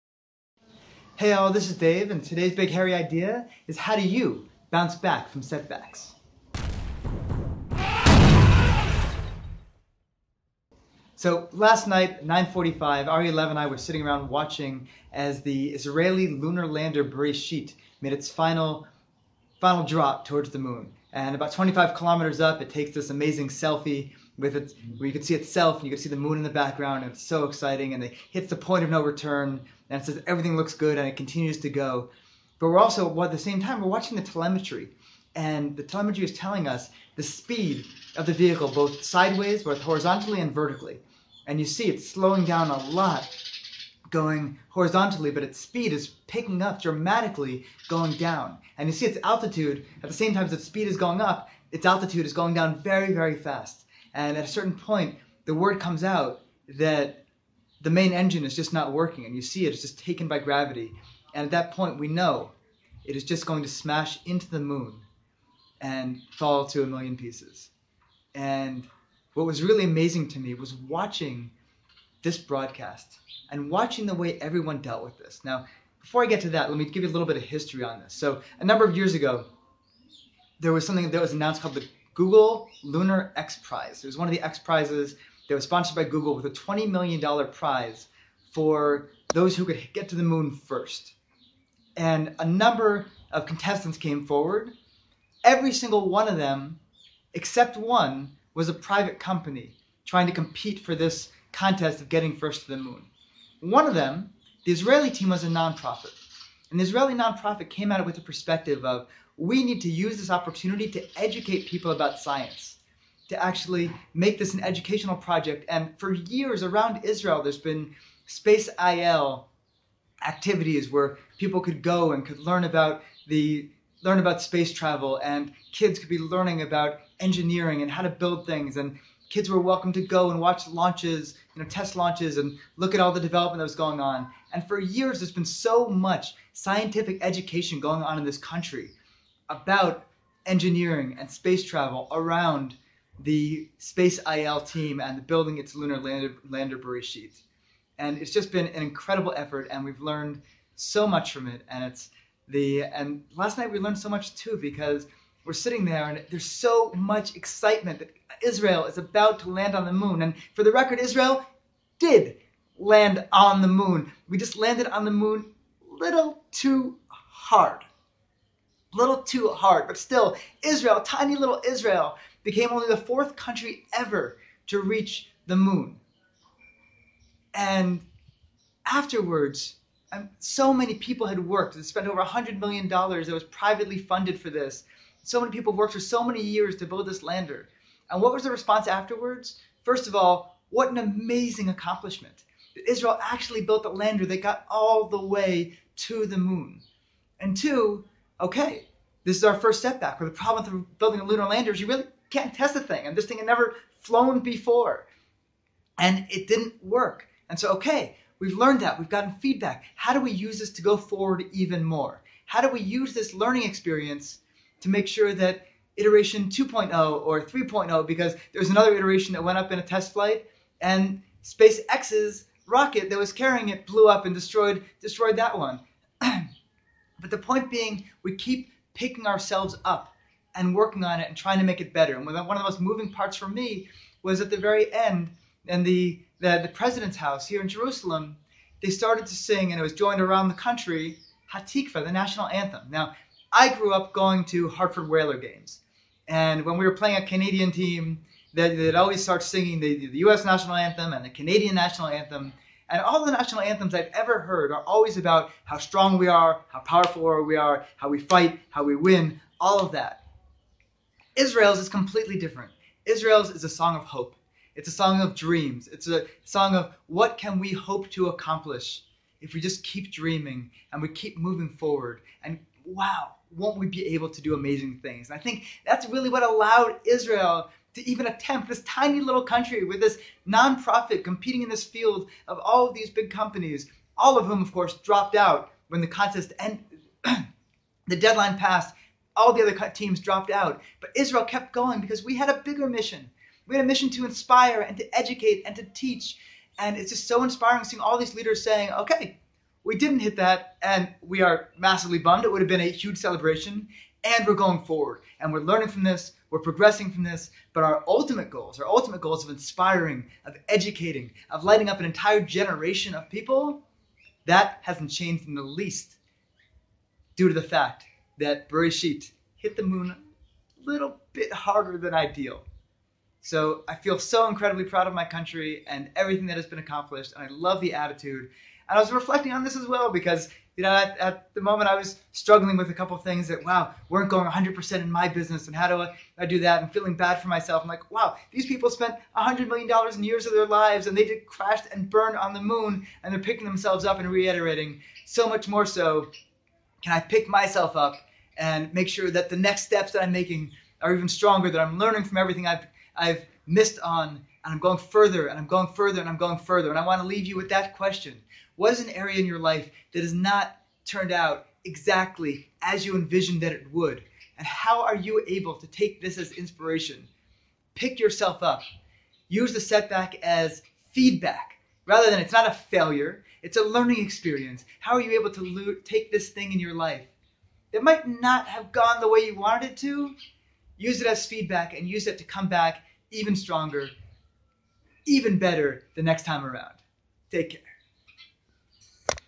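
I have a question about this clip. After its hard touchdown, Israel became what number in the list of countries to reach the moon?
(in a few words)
fourth.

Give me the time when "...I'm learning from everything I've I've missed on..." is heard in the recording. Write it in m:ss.
5:51.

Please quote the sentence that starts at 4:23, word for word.
Israel's is a song of hope.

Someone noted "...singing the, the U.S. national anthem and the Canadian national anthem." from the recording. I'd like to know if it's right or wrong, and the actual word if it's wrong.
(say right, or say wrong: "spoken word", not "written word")
right.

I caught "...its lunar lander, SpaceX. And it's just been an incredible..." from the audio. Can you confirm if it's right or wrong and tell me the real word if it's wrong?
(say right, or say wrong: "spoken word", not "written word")
wrong: "Bereshit", not "SpaceX".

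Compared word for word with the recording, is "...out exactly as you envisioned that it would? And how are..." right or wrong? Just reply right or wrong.
right.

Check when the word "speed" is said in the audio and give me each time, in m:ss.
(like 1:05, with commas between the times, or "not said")
0:37, 0:45, 0:50.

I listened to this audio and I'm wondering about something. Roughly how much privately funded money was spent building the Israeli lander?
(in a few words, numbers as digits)
over $100 million.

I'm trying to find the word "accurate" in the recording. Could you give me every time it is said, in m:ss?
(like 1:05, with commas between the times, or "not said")
not said.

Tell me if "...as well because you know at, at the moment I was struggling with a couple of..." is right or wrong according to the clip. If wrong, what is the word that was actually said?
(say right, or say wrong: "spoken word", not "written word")
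right.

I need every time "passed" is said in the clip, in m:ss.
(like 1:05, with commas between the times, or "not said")
4:48.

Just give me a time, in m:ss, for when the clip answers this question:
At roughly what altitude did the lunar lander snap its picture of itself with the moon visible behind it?
0:21.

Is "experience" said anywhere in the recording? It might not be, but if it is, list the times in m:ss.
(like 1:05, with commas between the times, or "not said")
3:33, 6:14.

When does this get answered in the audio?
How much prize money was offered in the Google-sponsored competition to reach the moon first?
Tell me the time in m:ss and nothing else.
1:26.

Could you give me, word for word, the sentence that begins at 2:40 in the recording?
And for the record, Israel did land on the moon.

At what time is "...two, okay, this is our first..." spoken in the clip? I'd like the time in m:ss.
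3:17.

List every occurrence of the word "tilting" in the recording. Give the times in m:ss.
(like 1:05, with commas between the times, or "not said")
not said.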